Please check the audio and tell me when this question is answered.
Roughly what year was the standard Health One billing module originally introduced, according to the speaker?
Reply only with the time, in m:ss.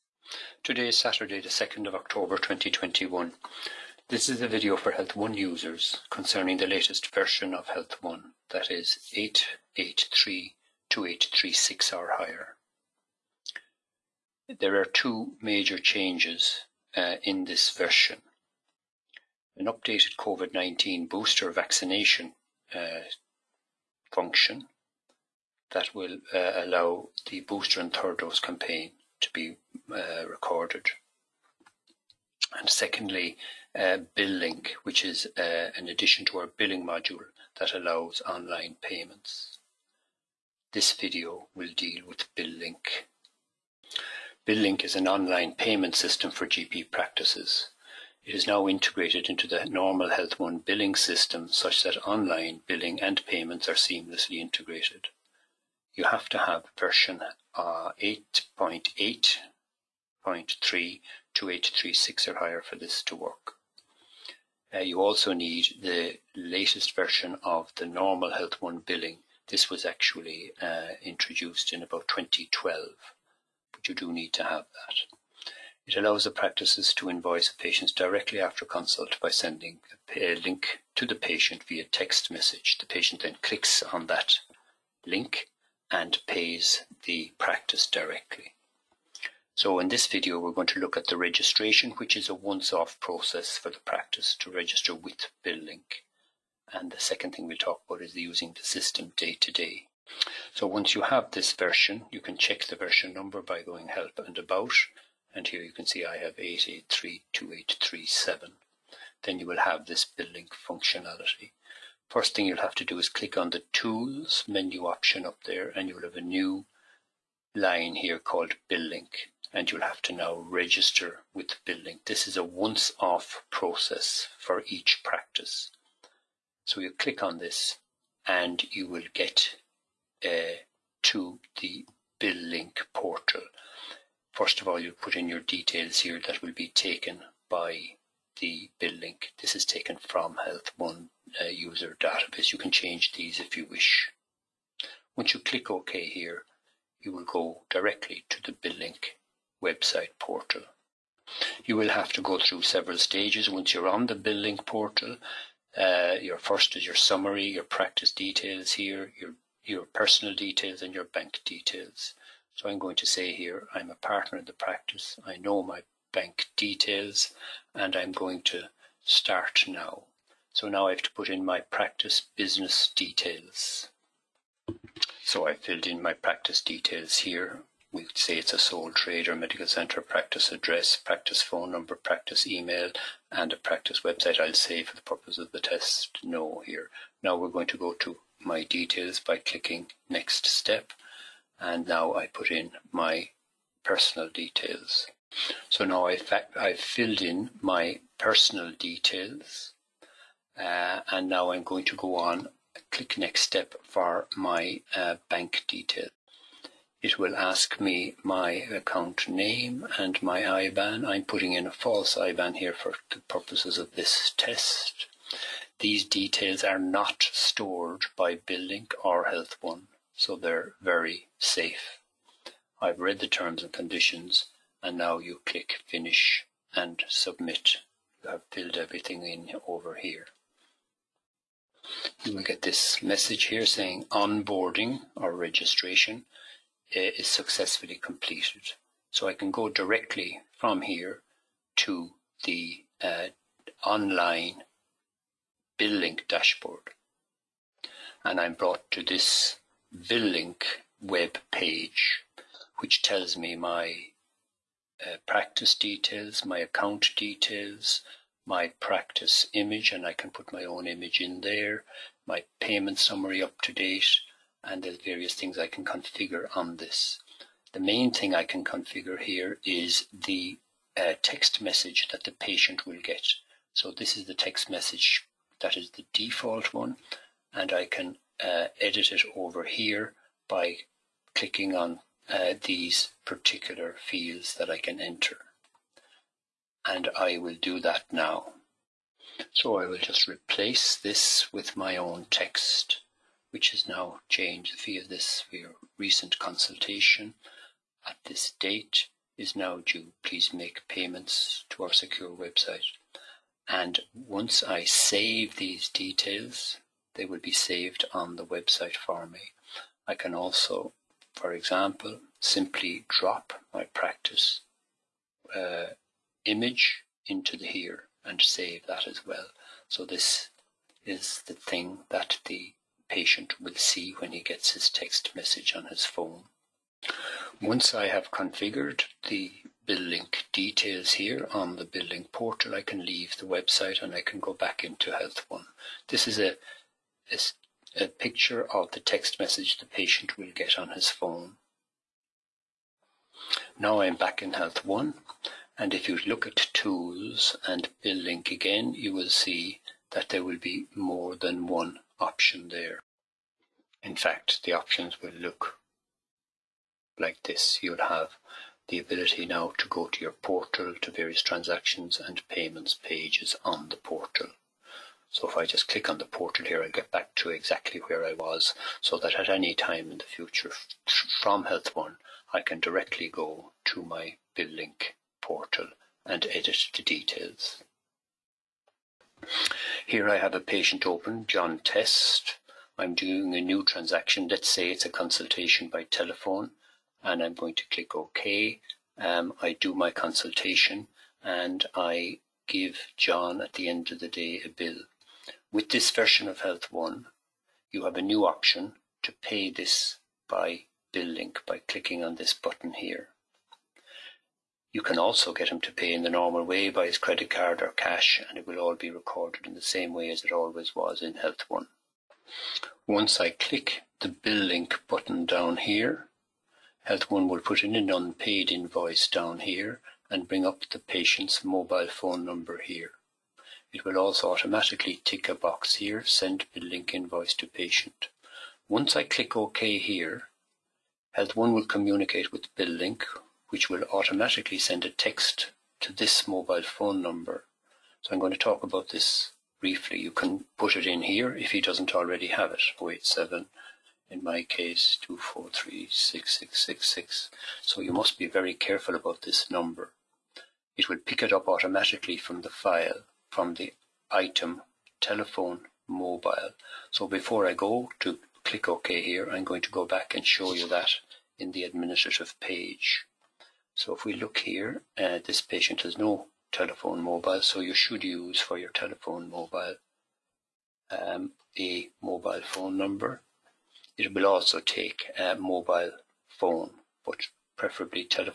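1:12.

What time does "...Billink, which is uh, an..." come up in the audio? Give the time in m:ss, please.
0:34.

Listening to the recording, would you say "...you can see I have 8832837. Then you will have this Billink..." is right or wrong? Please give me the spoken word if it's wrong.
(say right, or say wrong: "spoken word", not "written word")
right.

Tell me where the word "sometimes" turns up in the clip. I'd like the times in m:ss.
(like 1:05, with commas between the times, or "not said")
not said.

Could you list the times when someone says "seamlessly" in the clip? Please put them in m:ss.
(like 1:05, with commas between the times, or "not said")
0:53.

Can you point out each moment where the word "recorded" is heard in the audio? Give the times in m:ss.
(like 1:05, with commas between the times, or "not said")
0:30, 6:49.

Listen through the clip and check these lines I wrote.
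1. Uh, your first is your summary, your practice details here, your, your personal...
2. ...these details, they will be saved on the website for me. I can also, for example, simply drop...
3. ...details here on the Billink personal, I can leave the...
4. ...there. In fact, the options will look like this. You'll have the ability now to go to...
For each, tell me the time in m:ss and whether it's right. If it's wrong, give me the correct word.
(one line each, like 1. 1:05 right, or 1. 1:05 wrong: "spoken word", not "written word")
1. 2:35 right
2. 5:05 right
3. 5:30 wrong: "portal", not "personal"
4. 5:52 right.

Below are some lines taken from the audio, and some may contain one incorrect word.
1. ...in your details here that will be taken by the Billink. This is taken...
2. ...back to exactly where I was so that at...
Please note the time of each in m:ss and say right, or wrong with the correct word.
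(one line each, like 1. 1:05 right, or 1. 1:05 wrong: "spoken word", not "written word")
1. 2:15 right
2. 6:07 right.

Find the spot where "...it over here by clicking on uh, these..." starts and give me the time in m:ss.
4:39.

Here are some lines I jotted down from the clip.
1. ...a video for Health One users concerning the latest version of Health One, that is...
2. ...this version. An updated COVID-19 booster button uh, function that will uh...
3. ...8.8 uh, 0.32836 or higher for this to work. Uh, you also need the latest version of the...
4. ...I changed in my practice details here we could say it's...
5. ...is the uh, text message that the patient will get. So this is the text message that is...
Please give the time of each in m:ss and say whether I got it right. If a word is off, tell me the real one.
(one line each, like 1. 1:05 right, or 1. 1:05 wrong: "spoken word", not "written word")
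1. 0:04 right
2. 0:17 wrong: "vaccination", not "button"
3. 0:57 right
4. 2:55 wrong: "filled", not "changed"
5. 4:29 right.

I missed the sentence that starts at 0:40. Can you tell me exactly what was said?
This video will deal with Billink.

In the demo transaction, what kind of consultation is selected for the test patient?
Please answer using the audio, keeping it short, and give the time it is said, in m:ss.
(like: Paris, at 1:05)
Consultation by telephone, at 6:25.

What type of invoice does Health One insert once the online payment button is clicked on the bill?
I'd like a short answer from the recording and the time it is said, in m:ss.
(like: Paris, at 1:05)
Unpaid invoice, at 6:58.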